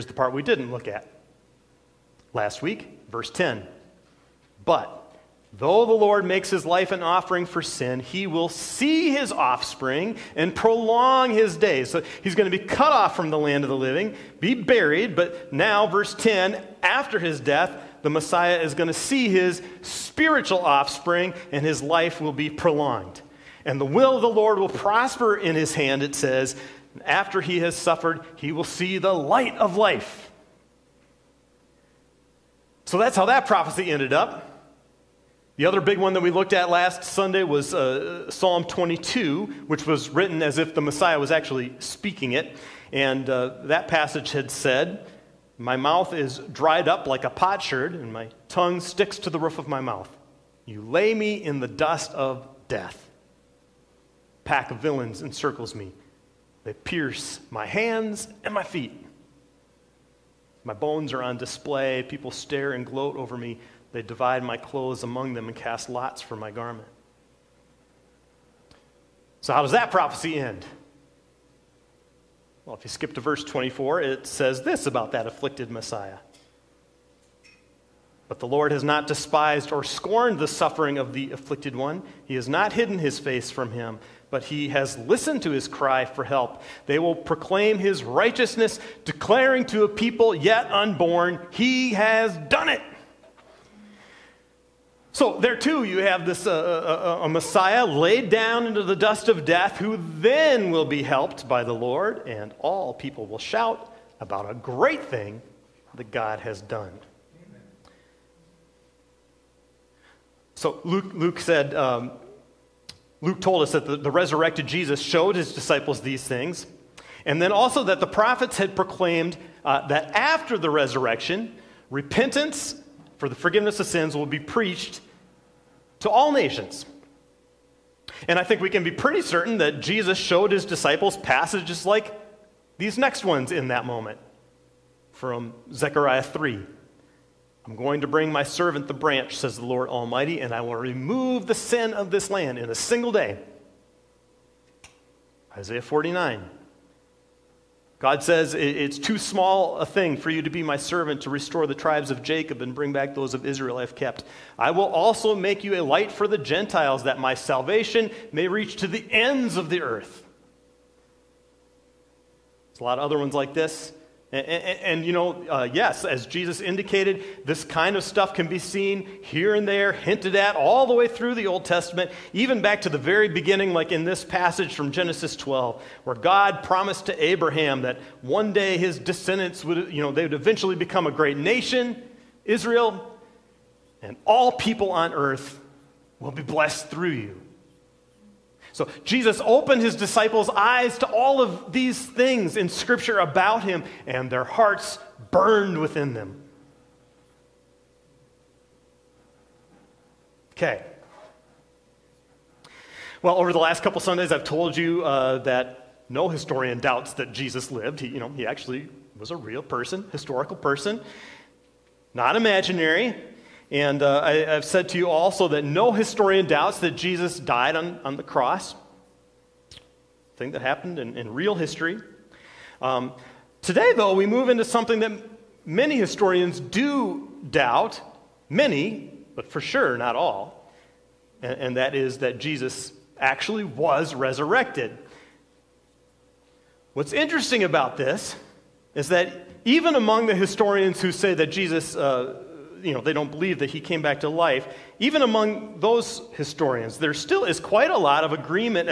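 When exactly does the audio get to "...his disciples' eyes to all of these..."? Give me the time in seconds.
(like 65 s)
189 s.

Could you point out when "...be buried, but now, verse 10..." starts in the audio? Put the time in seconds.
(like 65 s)
14 s.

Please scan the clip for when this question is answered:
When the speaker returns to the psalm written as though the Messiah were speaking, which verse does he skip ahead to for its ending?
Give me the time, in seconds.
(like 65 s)
73 s.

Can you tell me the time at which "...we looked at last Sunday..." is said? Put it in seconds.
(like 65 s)
36 s.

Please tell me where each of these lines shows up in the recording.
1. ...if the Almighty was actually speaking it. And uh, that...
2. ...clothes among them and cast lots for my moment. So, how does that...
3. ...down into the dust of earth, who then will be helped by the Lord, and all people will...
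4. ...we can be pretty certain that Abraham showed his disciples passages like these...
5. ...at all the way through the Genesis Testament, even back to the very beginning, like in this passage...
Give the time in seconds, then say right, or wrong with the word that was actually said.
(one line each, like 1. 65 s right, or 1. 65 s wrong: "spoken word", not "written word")
1. 40 s wrong: "Messiah", not "Almighty"
2. 64 s wrong: "garment", not "moment"
3. 98 s wrong: "death", not "earth"
4. 128 s wrong: "Jesus", not "Abraham"
5. 170 s wrong: "Old", not "Genesis".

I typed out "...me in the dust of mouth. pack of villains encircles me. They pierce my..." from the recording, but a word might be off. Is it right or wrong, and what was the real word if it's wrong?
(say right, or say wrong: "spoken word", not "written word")
wrong: "death", not "mouth".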